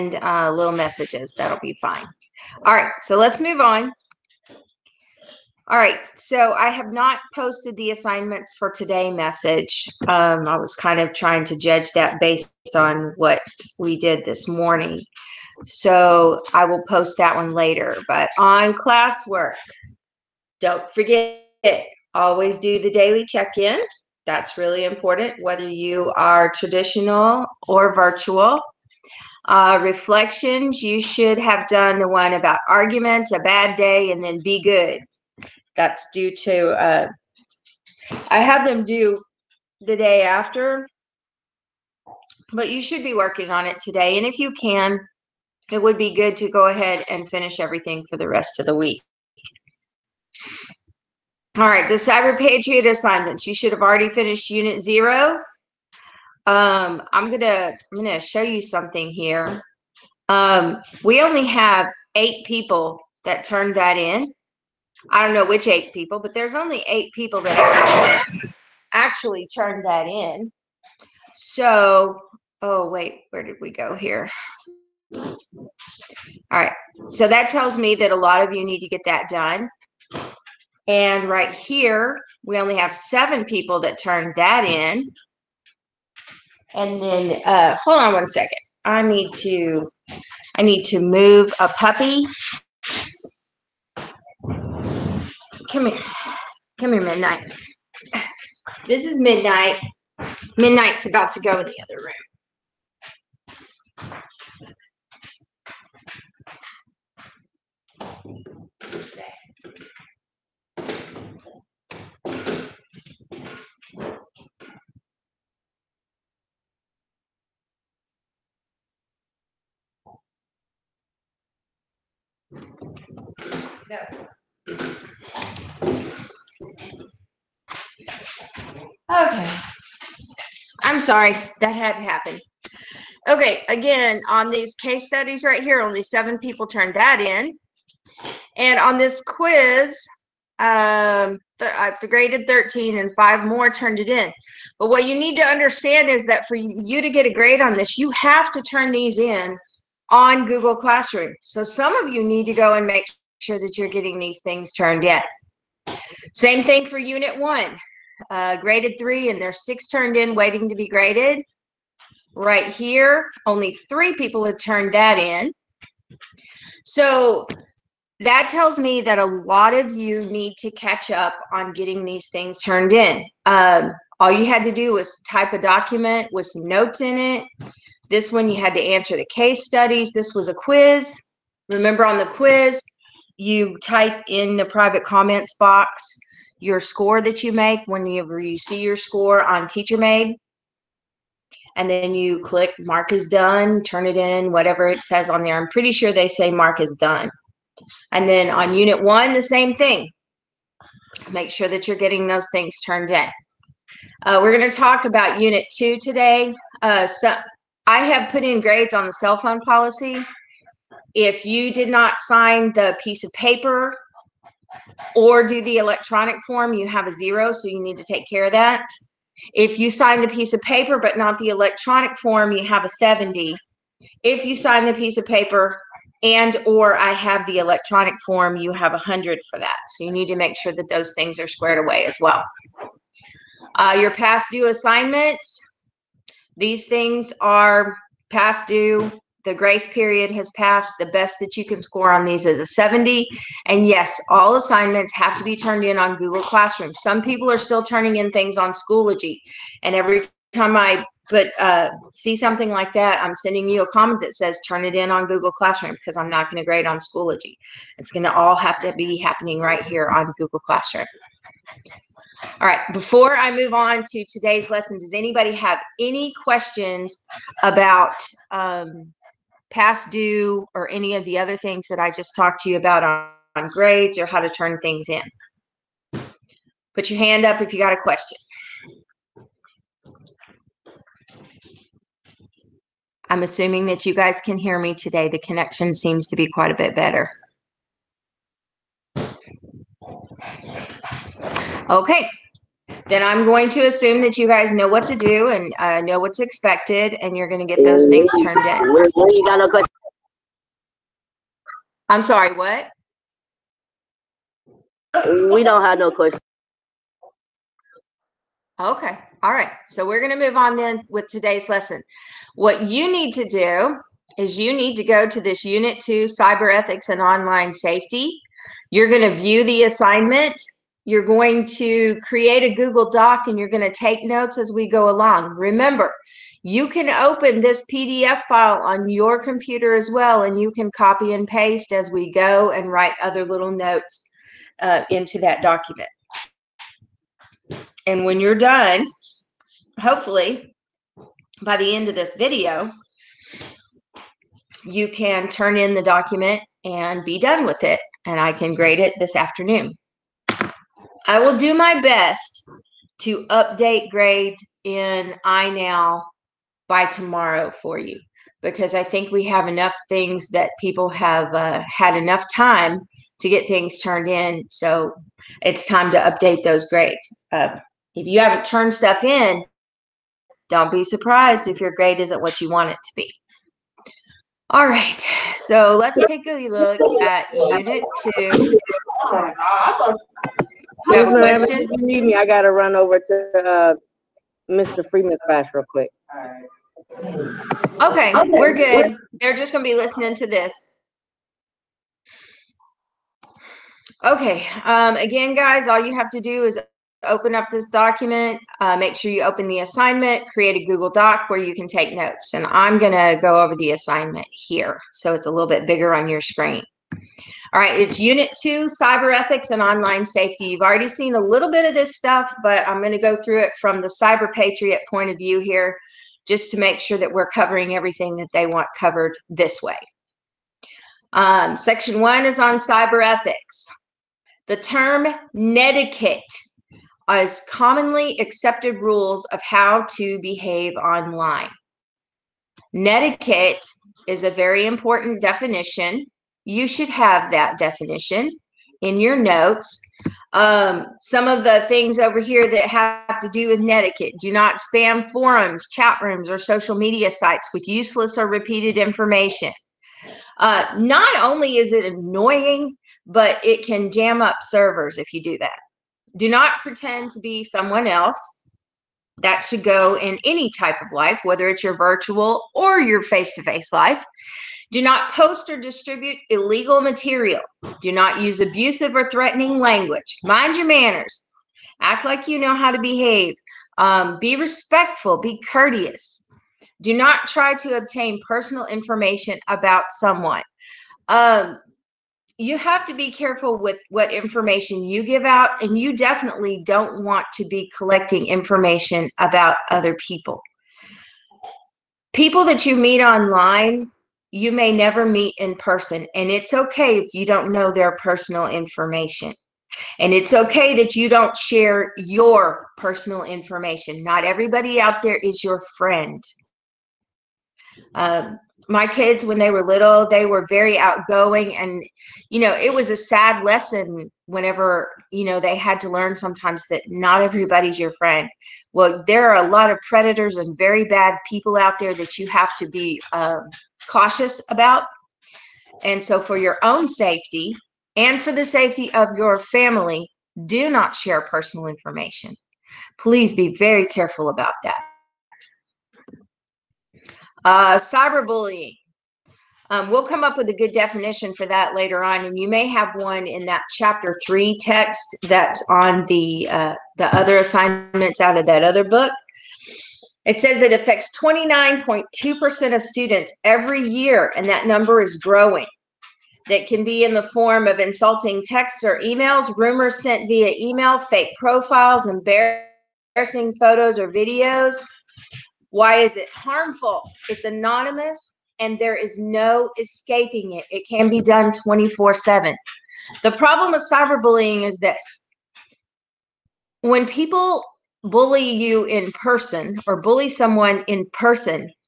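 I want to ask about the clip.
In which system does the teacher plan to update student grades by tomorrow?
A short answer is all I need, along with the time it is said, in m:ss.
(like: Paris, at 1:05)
iNow, at 5:55.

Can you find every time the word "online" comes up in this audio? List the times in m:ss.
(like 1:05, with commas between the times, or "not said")
5:17, 6:49, 7:10, 8:13.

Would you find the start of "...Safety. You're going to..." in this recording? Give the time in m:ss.
5:17.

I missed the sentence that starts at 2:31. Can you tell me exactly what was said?
So some of you need to go and make sure that you're getting these things turned in.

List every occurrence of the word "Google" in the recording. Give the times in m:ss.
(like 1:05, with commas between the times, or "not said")
2:30, 4:06, 4:15, 4:20, 5:22, 6:40.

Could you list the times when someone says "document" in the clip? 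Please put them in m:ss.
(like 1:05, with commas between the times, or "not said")
2:55, 5:35, 5:46, 6:37.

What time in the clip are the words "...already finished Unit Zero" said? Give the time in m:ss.
0:53.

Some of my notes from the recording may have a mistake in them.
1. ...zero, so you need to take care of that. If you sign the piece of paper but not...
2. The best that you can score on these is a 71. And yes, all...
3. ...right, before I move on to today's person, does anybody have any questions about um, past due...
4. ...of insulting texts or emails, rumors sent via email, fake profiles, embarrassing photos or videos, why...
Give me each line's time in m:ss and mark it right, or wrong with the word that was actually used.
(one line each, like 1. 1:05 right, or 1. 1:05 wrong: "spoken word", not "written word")
1. 3:37 right
2. 4:00 wrong: "70", not "71"
3. 4:22 wrong: "lesson", not "person"
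4. 9:17 right.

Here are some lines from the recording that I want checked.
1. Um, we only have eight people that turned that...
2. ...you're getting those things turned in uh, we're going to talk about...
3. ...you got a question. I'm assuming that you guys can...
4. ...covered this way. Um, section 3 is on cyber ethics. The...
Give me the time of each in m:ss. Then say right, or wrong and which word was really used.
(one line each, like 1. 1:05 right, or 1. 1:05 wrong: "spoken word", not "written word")
1. 1:00 right
2. 3:21 right
3. 4:37 right
4. 6:58 wrong: "1", not "3".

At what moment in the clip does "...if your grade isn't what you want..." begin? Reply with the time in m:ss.
6:11.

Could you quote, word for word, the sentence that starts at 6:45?
So it's a little bit bigger on your screen.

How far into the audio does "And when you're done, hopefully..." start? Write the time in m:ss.
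5:38.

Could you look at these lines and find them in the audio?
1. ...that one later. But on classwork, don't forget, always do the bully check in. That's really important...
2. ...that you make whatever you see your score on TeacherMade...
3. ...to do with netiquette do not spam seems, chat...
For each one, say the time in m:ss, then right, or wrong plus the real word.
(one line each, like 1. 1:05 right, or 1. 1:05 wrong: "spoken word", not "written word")
1. 0:17 wrong: "daily", not "bully"
2. 3:07 wrong: "whenever", not "whatever"
3. 7:23 wrong: "forums", not "seems".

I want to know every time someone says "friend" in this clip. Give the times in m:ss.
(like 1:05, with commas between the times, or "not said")
8:25, 8:38.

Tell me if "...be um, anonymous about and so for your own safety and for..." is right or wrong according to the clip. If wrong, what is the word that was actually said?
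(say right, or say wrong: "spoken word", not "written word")
wrong: "cautious", not "anonymous".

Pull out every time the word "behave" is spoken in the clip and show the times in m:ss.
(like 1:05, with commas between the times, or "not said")
7:10, 7:52.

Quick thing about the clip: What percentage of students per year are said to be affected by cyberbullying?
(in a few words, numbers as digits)
29.2%.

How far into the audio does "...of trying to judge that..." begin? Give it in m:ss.
0:10.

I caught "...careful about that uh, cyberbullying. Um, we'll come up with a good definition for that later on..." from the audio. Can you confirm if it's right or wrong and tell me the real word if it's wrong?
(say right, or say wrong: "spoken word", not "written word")
right.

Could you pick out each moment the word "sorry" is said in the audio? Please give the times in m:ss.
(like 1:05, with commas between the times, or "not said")
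2:10, 5:02.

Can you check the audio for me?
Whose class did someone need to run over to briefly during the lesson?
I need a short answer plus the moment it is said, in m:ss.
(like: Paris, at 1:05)
Mr. Freeman, at 6:24.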